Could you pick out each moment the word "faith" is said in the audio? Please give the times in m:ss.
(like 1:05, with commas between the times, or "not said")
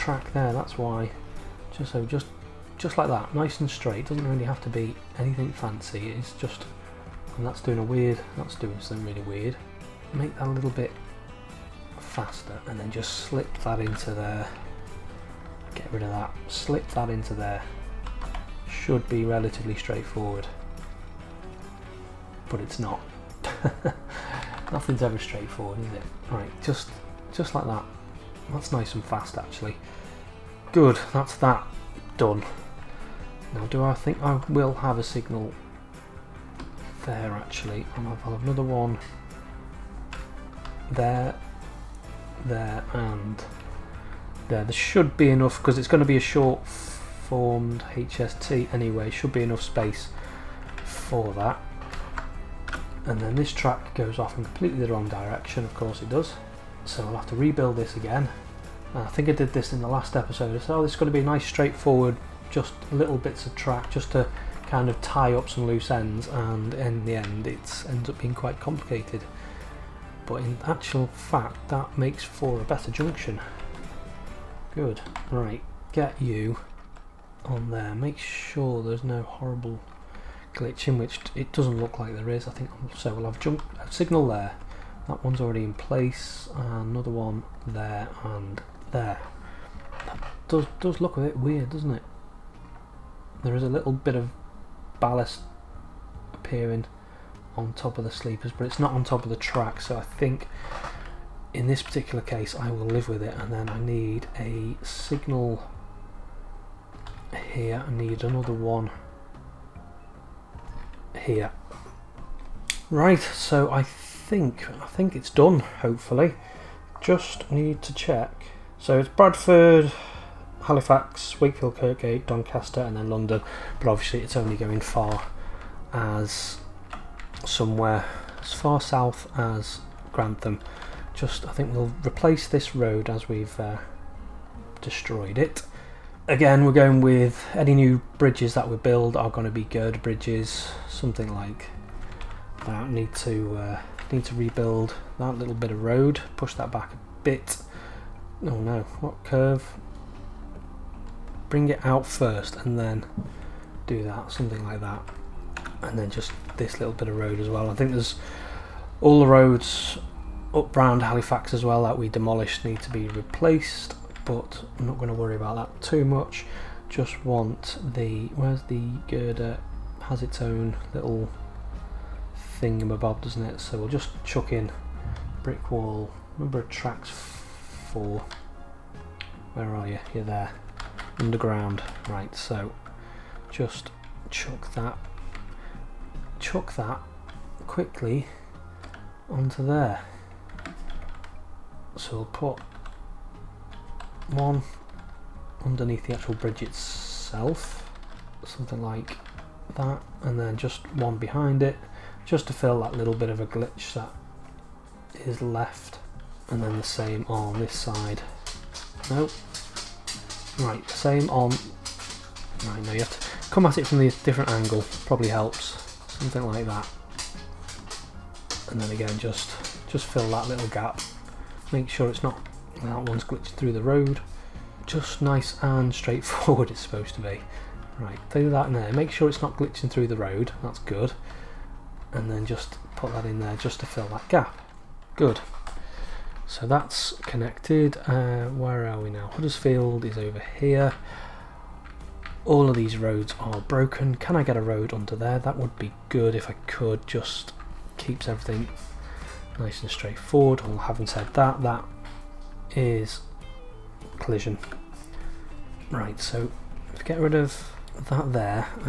not said.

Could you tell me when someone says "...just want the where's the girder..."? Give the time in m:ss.
2:46.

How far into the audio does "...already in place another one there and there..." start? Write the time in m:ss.
1:25.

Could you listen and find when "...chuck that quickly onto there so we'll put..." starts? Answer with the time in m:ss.
3:06.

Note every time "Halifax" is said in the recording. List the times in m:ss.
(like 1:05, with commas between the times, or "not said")
2:00, 2:41.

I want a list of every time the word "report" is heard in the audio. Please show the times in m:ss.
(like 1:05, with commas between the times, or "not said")
not said.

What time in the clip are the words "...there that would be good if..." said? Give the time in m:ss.
4:05.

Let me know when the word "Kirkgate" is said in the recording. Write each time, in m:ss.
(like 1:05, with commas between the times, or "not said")
2:01.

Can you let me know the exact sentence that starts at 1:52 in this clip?
Right, so I think I think it's done, hopefully.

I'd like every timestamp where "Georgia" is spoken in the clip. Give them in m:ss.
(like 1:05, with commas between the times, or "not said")
not said.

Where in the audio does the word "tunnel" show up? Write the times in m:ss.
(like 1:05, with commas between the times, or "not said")
not said.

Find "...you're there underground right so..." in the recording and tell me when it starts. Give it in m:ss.
3:00.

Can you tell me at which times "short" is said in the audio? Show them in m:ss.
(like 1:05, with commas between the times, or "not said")
0:46.